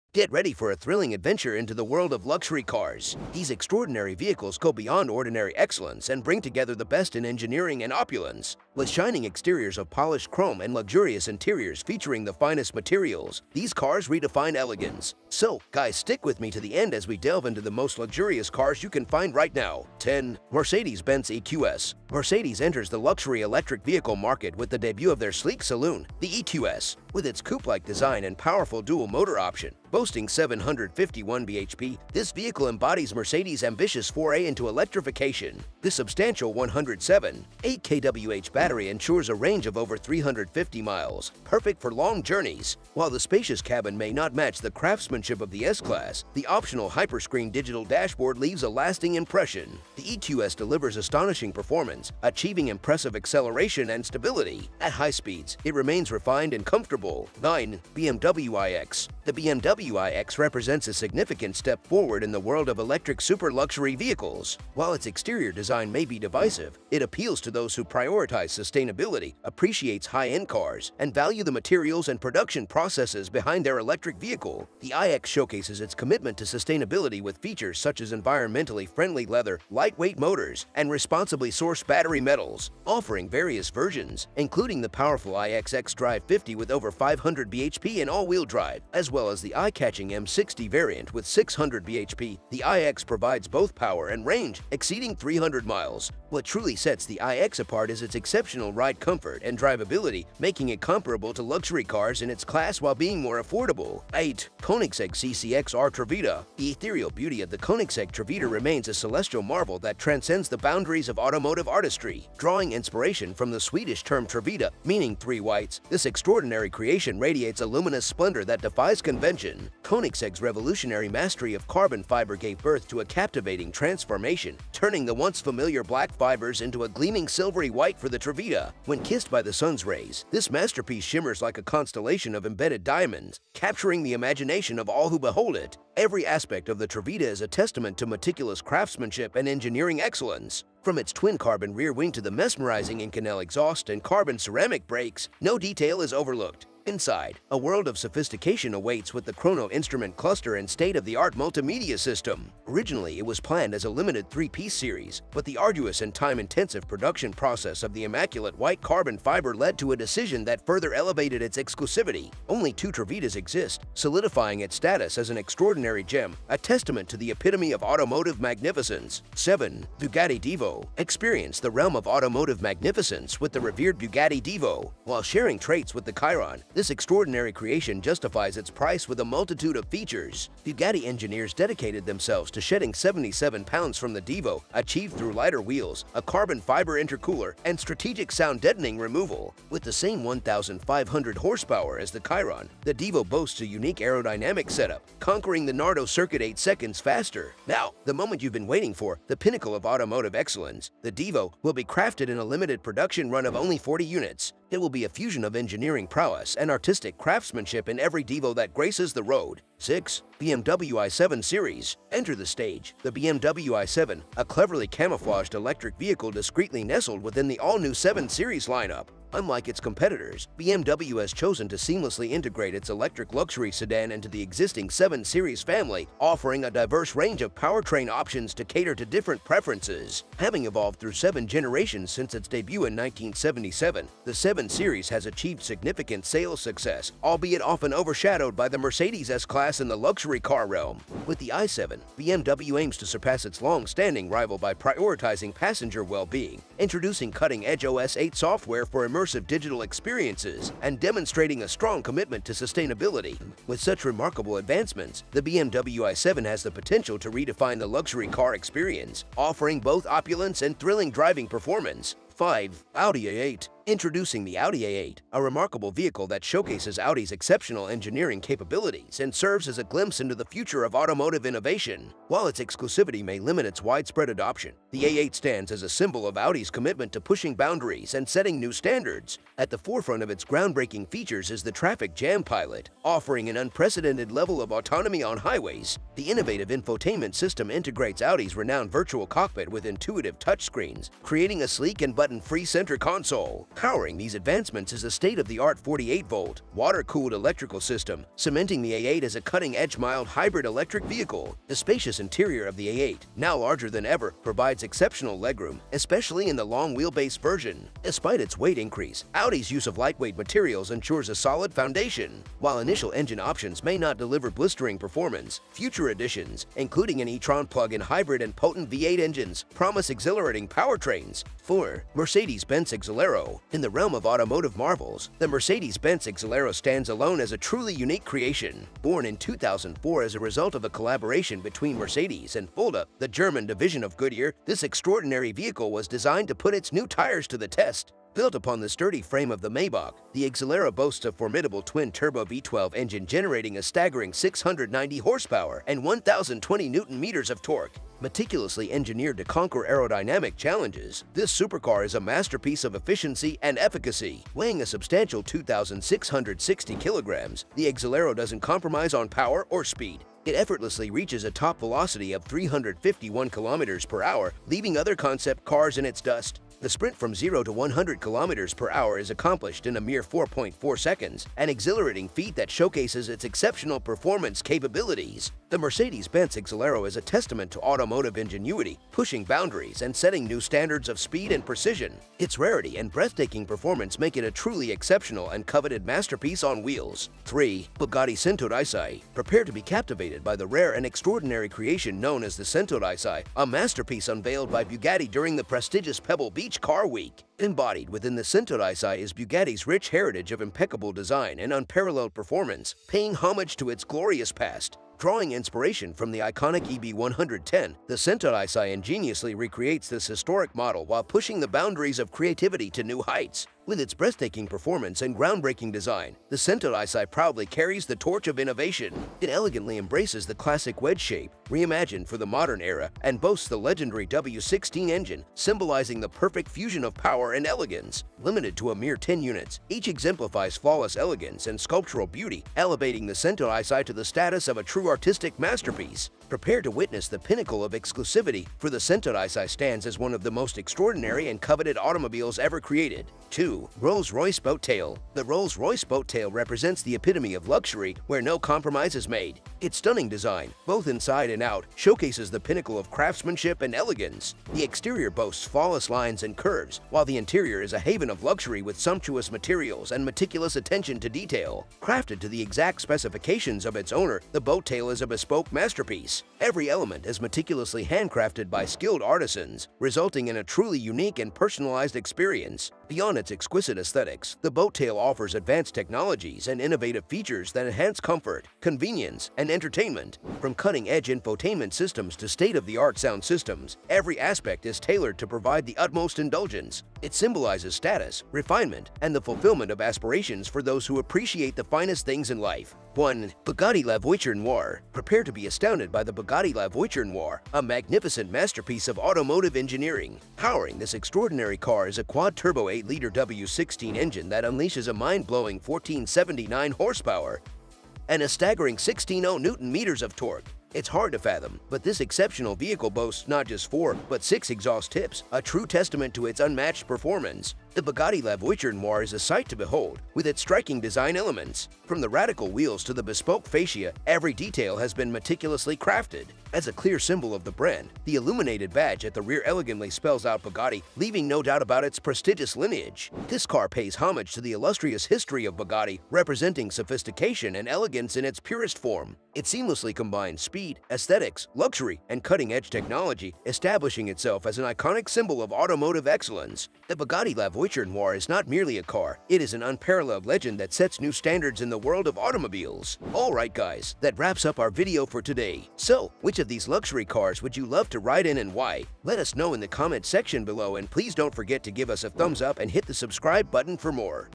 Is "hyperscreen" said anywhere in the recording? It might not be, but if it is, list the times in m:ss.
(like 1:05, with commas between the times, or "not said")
0:46.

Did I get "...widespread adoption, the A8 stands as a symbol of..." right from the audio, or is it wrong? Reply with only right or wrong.
right.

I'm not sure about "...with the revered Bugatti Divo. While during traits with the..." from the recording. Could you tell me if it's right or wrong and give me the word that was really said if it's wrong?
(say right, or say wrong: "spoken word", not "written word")
wrong: "sharing", not "during".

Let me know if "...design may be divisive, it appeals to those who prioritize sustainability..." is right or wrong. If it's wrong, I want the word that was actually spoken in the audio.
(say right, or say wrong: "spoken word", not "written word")
right.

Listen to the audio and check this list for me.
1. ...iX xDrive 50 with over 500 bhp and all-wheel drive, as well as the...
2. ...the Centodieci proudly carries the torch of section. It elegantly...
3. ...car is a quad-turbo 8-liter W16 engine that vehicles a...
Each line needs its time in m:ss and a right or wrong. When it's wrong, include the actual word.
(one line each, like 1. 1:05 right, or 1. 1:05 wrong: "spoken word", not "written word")
1. 1:25 right
2. 6:56 wrong: "innovation", not "section"
3. 8:21 wrong: "unleashes", not "vehicles".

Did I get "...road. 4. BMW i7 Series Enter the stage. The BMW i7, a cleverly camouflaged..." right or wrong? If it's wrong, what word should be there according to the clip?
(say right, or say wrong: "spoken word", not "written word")
wrong: "6", not "4".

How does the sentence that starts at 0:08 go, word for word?
With shining exteriors of polished chrome and luxurious interiors featuring the finest materials, these cars redefine elegance.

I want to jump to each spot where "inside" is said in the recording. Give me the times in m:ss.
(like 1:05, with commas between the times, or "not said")
2:26, 7:31.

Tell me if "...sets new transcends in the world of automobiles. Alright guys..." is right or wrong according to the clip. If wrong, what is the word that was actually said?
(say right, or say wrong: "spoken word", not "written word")
wrong: "standards", not "transcends".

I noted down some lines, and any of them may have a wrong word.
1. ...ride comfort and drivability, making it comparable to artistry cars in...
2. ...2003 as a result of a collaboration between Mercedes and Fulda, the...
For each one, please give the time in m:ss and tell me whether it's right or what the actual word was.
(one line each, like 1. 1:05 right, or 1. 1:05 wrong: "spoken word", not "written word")
1. 1:38 wrong: "luxury", not "artistry"
2. 5:29 wrong: "2004", not "2003".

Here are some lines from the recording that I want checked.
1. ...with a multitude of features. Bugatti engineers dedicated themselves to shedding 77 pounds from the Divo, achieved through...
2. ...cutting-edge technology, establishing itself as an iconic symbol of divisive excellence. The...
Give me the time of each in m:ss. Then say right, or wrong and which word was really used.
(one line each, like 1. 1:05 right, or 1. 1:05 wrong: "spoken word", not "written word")
1. 2:59 right
2. 9:02 wrong: "automotive", not "divisive".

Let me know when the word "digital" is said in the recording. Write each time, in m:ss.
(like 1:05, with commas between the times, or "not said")
0:47, 4:09.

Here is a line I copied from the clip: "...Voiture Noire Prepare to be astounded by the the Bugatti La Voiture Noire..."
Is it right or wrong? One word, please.
right.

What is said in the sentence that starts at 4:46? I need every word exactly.
The innovative infotainment system integrates Audi's renowned virtual cockpit with intuitive touchscreens, creating a sleek and button-free center console.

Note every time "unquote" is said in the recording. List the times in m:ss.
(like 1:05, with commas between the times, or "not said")
not said.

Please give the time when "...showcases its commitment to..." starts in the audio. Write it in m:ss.
1:15.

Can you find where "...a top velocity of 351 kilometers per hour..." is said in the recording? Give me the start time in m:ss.
6:01.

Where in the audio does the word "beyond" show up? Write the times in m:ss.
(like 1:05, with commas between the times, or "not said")
0:04, 7:53.